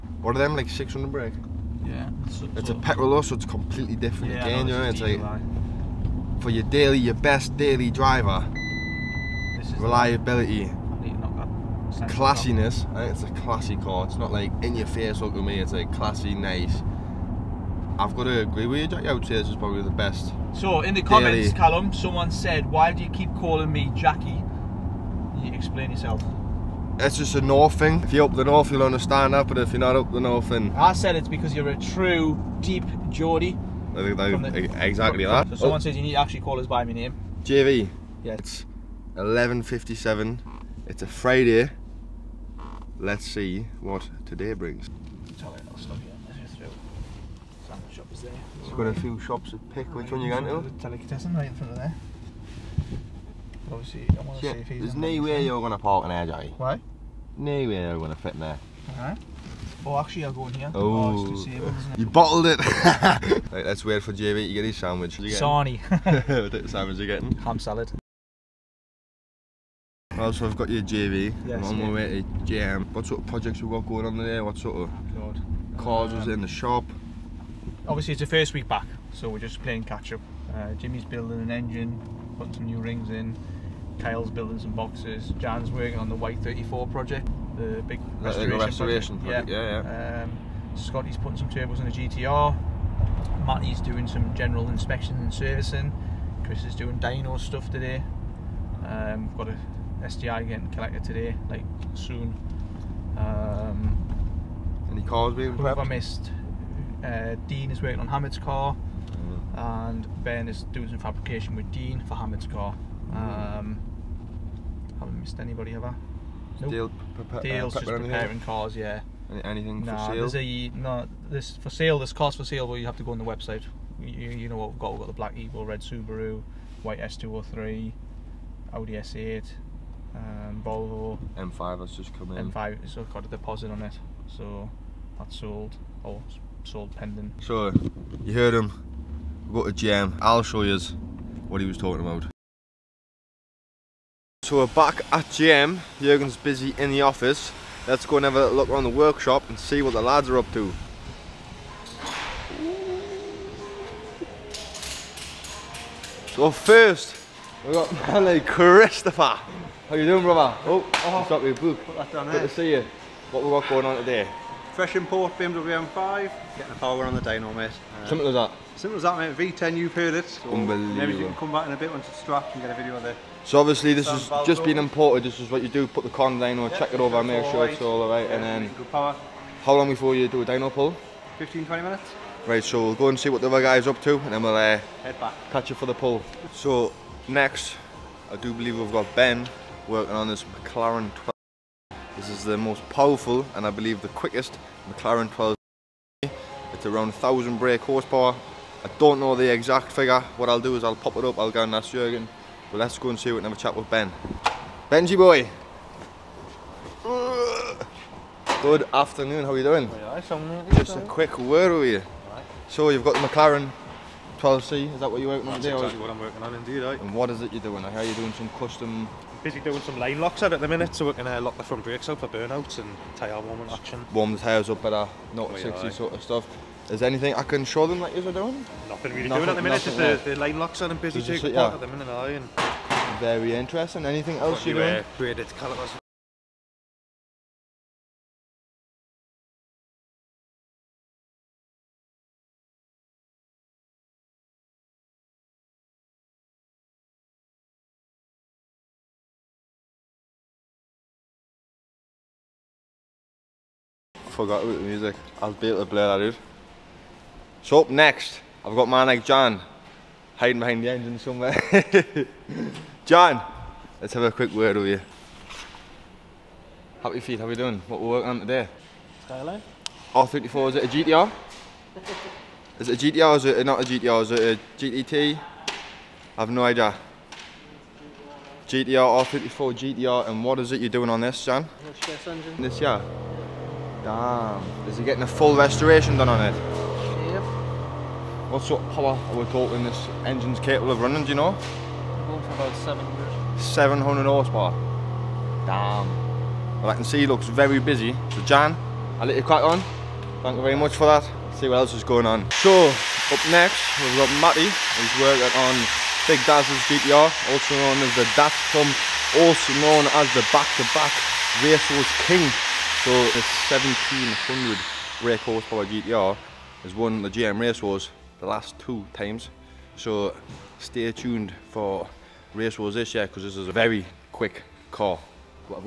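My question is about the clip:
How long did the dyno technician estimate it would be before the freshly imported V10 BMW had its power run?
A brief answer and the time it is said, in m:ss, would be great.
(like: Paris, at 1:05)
15 to 20 minutes, at 3:01.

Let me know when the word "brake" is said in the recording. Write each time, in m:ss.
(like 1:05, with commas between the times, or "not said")
0:01, 3:17, 3:41.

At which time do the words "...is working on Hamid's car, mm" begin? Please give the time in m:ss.
1:47.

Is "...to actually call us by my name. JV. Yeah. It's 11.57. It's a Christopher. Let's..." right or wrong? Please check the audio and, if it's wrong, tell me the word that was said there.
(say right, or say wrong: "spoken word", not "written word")
wrong: "Friday", not "Christopher".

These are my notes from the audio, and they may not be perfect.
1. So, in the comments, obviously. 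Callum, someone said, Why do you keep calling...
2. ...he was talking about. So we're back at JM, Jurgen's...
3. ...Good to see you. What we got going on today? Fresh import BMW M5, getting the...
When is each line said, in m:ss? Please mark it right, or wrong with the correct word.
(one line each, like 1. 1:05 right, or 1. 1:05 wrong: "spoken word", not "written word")
1. 0:20 wrong: "daily", not "obviously"
2. 2:21 right
3. 2:42 right.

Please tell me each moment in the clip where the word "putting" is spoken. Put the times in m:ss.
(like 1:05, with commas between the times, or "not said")
1:22, 1:31.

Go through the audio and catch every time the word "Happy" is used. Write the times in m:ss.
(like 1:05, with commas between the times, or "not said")
4:27.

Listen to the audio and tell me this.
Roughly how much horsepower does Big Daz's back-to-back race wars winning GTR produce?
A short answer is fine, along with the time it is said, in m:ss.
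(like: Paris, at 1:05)
1700, at 5:13.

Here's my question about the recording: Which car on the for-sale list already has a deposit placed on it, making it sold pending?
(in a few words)
M5.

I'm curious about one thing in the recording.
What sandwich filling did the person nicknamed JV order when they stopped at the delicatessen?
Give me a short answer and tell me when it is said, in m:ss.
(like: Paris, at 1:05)
Ham salad, at 1:07.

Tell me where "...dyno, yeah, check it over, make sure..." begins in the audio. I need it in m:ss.
2:56.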